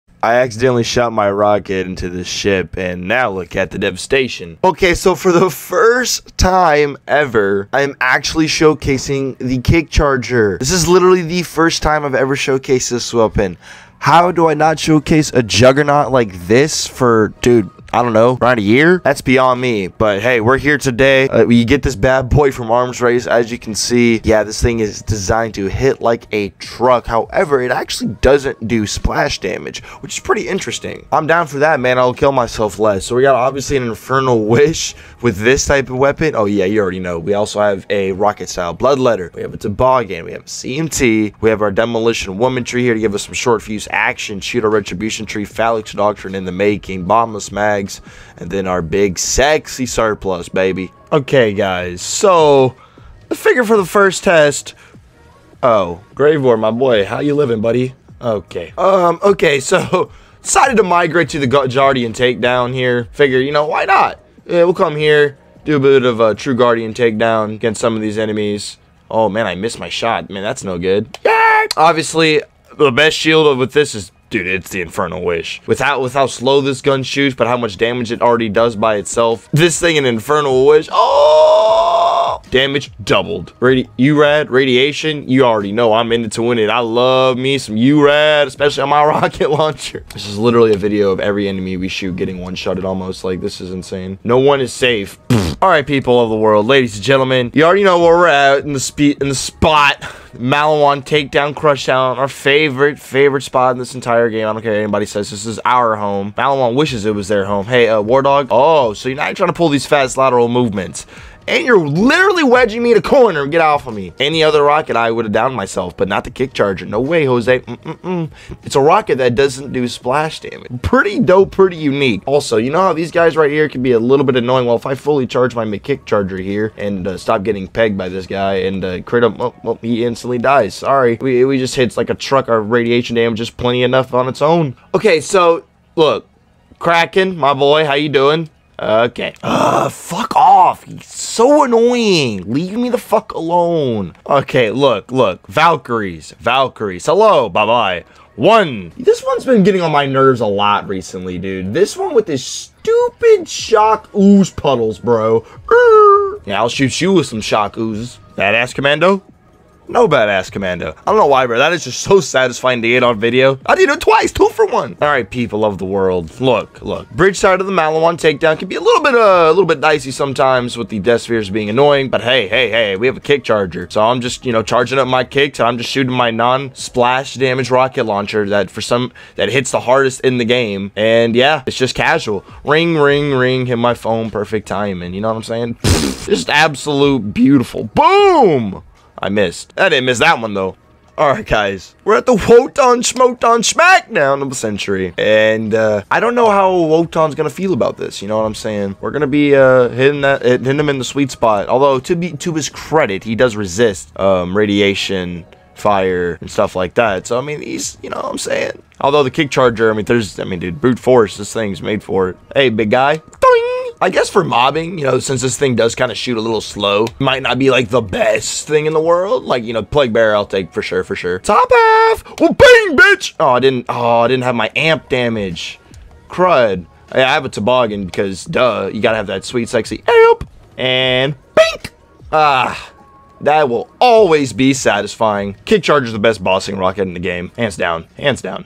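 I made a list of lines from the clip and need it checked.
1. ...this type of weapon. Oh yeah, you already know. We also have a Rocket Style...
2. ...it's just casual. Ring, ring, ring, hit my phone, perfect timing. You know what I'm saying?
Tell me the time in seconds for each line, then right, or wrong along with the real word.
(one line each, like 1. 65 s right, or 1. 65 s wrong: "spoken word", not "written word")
1. 35 s right
2. 181 s right.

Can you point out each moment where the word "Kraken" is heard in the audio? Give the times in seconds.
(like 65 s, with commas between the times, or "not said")
136 s.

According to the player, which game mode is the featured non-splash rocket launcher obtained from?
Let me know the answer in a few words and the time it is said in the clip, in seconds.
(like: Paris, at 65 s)
Arms Race, at 22 s.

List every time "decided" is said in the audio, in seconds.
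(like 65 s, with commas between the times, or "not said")
60 s.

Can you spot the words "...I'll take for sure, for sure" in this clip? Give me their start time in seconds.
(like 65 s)
220 s.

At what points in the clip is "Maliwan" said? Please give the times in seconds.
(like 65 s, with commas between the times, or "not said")
100 s, 106 s, 167 s.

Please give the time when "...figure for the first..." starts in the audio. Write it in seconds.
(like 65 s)
53 s.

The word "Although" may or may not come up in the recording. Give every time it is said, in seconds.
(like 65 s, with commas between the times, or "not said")
201 s, 209 s.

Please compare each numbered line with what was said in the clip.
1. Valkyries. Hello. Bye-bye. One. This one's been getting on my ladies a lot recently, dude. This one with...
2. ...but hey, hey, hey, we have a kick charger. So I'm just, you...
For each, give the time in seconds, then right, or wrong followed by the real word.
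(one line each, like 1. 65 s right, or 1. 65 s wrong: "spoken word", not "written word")
1. 146 s wrong: "nerves", not "ladies"
2. 172 s right.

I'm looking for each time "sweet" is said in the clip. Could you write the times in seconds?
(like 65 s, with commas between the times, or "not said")
201 s, 229 s.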